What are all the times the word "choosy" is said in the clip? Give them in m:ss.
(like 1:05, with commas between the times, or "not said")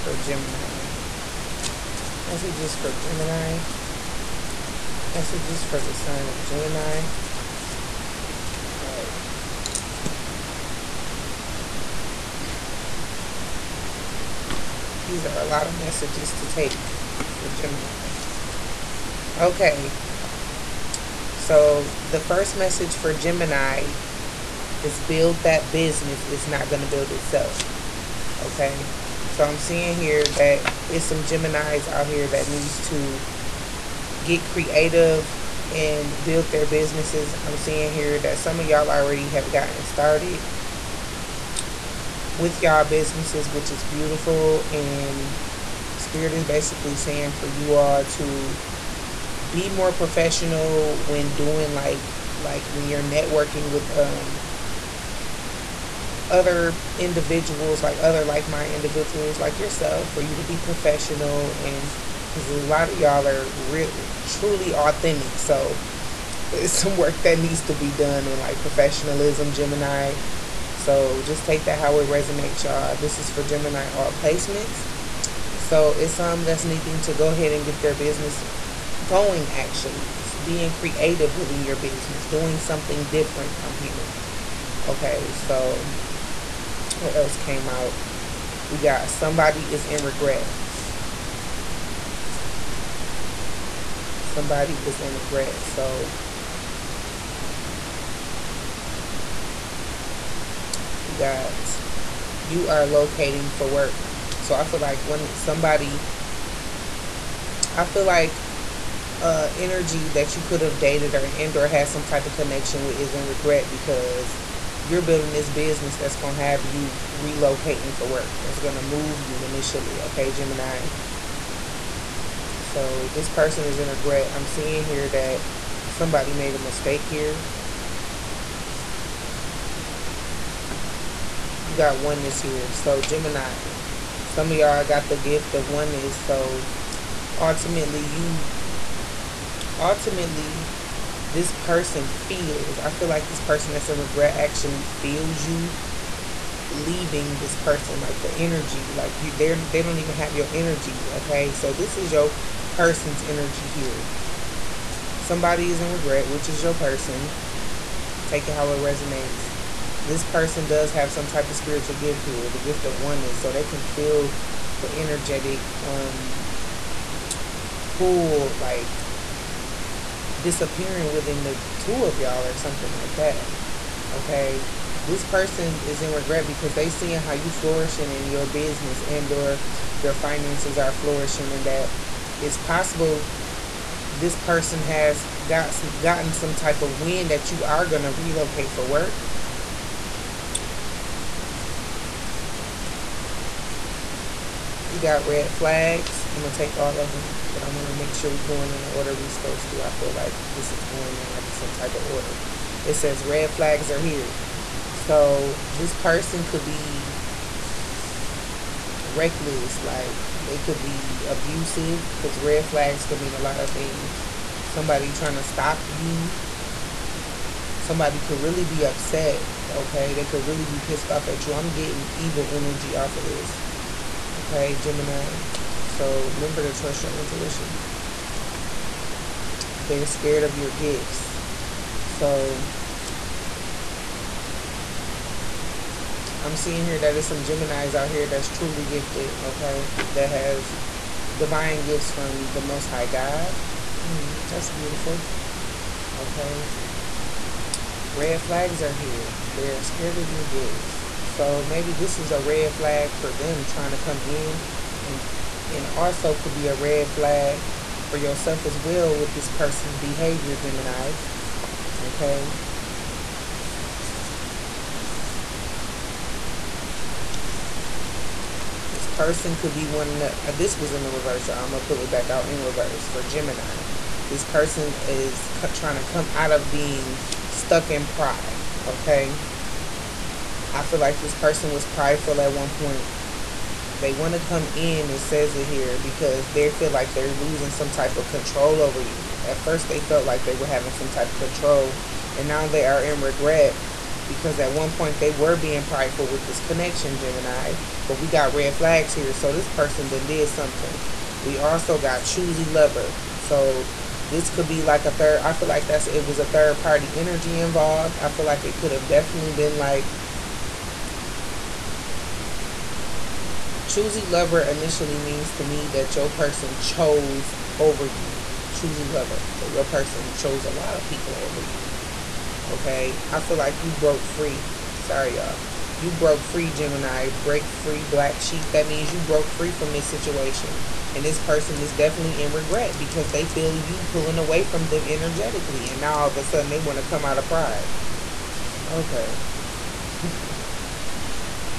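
5:02, 5:13, 5:18.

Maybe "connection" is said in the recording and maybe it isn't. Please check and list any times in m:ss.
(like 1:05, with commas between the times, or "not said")
1:52, 4:56.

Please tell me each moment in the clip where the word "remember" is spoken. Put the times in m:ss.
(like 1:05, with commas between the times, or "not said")
3:46.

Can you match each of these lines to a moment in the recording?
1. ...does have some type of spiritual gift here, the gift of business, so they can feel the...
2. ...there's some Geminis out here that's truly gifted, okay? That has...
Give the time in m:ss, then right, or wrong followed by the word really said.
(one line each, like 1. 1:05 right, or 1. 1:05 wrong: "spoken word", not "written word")
1. 2:40 wrong: "oneness", not "business"
2. 3:57 right.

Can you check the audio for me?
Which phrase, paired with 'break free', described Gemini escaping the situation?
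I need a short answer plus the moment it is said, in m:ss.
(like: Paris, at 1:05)
Black sheep, at 5:28.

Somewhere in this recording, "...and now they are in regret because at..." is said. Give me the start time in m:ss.
4:52.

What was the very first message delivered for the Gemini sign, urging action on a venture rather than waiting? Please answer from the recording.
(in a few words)
Build that business.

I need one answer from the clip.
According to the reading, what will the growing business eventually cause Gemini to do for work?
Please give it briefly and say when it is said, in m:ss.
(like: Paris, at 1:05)
Relocate, at 1:57.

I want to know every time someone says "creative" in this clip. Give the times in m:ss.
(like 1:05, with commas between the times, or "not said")
0:34, 1:20.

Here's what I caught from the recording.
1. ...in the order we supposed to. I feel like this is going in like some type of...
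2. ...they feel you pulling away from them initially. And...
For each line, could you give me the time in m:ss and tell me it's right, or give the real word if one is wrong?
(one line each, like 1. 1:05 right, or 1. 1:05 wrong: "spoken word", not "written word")
1. 3:18 right
2. 5:33 wrong: "energetically", not "initially".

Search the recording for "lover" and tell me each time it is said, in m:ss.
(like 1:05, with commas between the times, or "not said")
5:02, 5:14, 5:19.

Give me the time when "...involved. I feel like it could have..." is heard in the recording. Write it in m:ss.
5:07.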